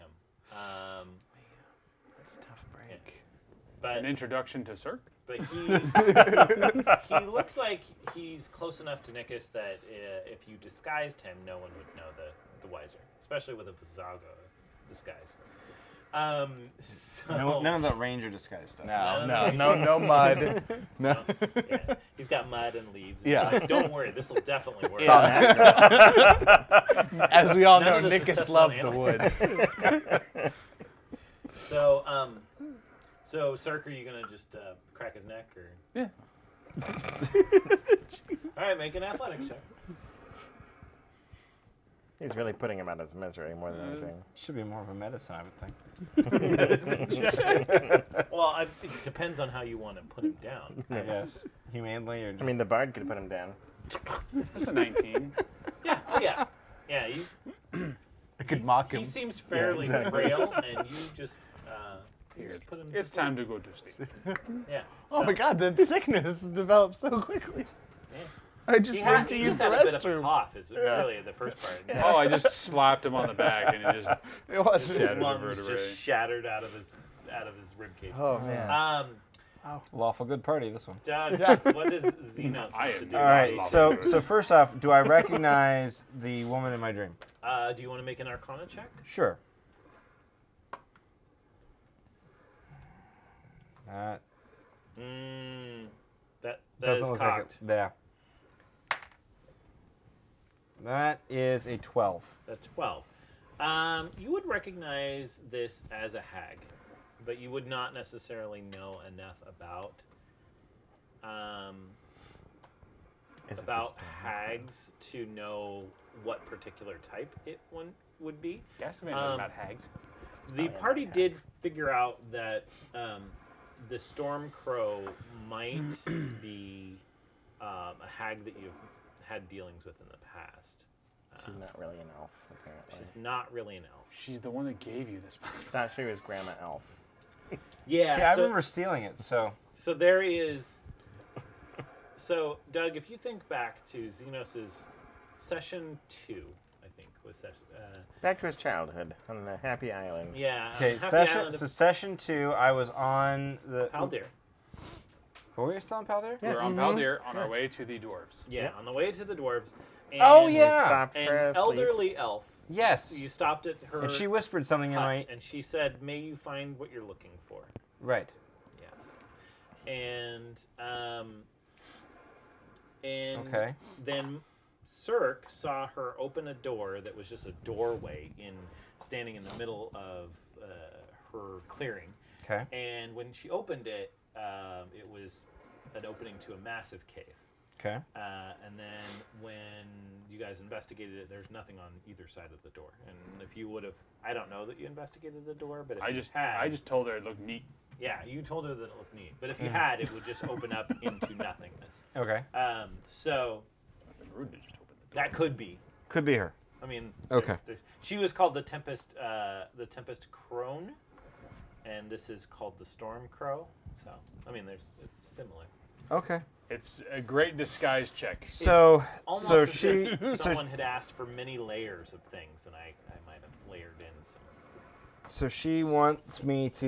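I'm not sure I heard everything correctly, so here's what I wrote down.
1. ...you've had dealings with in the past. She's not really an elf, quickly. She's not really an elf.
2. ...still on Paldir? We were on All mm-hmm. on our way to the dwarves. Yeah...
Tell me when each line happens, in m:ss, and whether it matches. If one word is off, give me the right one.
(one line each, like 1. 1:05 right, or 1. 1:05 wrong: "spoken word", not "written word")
1. 2:08 wrong: "apparently", not "quickly"
2. 2:35 wrong: "Paldir", not "All".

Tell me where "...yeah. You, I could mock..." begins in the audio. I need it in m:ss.
0:56.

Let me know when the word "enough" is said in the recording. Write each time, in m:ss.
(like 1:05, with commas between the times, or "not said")
0:08, 1:49.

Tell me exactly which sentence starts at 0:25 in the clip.
As we all none know, Nickus loved the woods.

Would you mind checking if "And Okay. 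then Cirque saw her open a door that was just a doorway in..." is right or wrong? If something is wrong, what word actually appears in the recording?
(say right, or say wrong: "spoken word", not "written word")
right.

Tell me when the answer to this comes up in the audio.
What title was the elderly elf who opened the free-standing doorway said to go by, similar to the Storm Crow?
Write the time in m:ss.
3:29.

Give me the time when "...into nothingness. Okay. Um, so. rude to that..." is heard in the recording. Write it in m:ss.
3:21.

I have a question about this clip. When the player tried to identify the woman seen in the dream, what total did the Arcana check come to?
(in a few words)
12.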